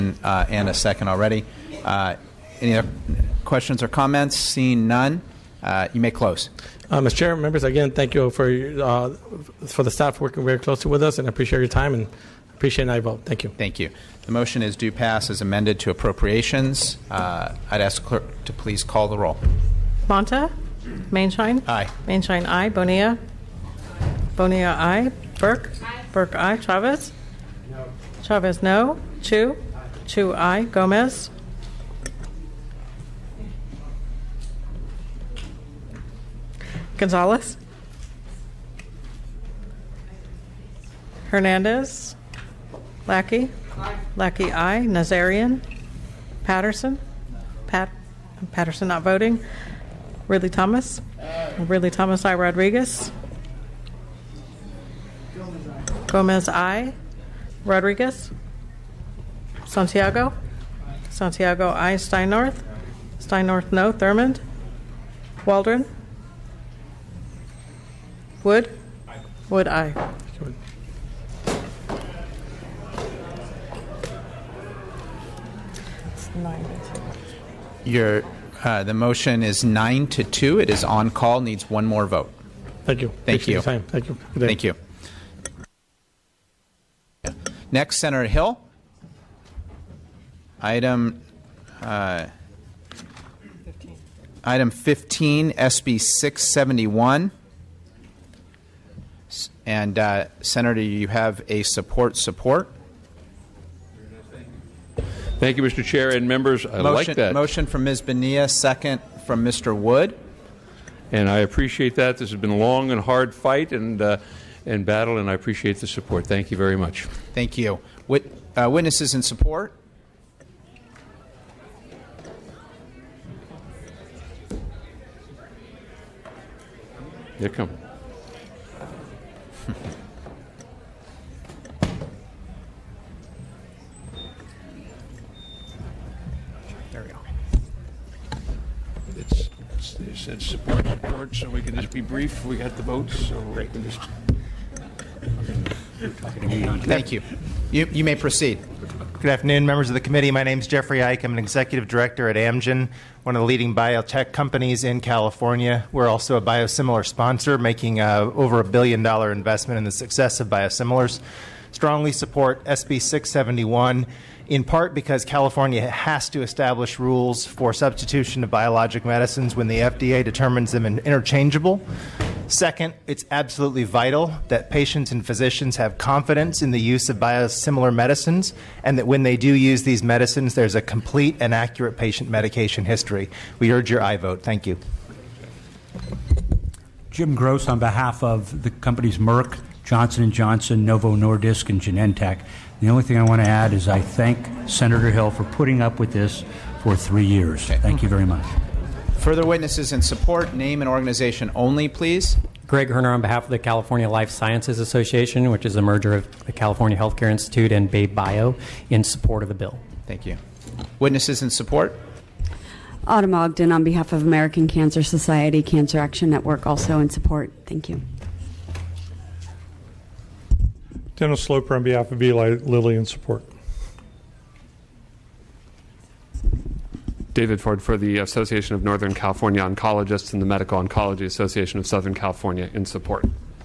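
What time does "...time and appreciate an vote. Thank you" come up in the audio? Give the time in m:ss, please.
0:11.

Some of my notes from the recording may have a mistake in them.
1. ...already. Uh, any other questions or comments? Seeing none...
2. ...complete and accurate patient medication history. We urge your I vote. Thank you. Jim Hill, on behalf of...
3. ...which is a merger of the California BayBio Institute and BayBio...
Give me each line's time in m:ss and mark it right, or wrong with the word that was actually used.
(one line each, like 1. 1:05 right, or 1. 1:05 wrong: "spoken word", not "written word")
1. 0:01 right
2. 3:00 wrong: "Gross", not "Hill"
3. 3:25 wrong: "Healthcare", not "BayBio".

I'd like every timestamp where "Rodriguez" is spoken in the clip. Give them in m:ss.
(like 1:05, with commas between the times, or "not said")
0:52, 0:57.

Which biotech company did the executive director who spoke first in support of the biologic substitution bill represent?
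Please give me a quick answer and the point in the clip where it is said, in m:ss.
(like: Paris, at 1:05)
Amgen, at 2:32.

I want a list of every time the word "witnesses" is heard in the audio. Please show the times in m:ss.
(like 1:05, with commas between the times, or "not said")
1:58, 3:19, 3:30.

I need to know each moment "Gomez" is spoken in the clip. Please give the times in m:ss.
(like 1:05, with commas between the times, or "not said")
0:30, 0:56.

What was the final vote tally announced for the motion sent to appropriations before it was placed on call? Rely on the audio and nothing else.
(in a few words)
9 to 2.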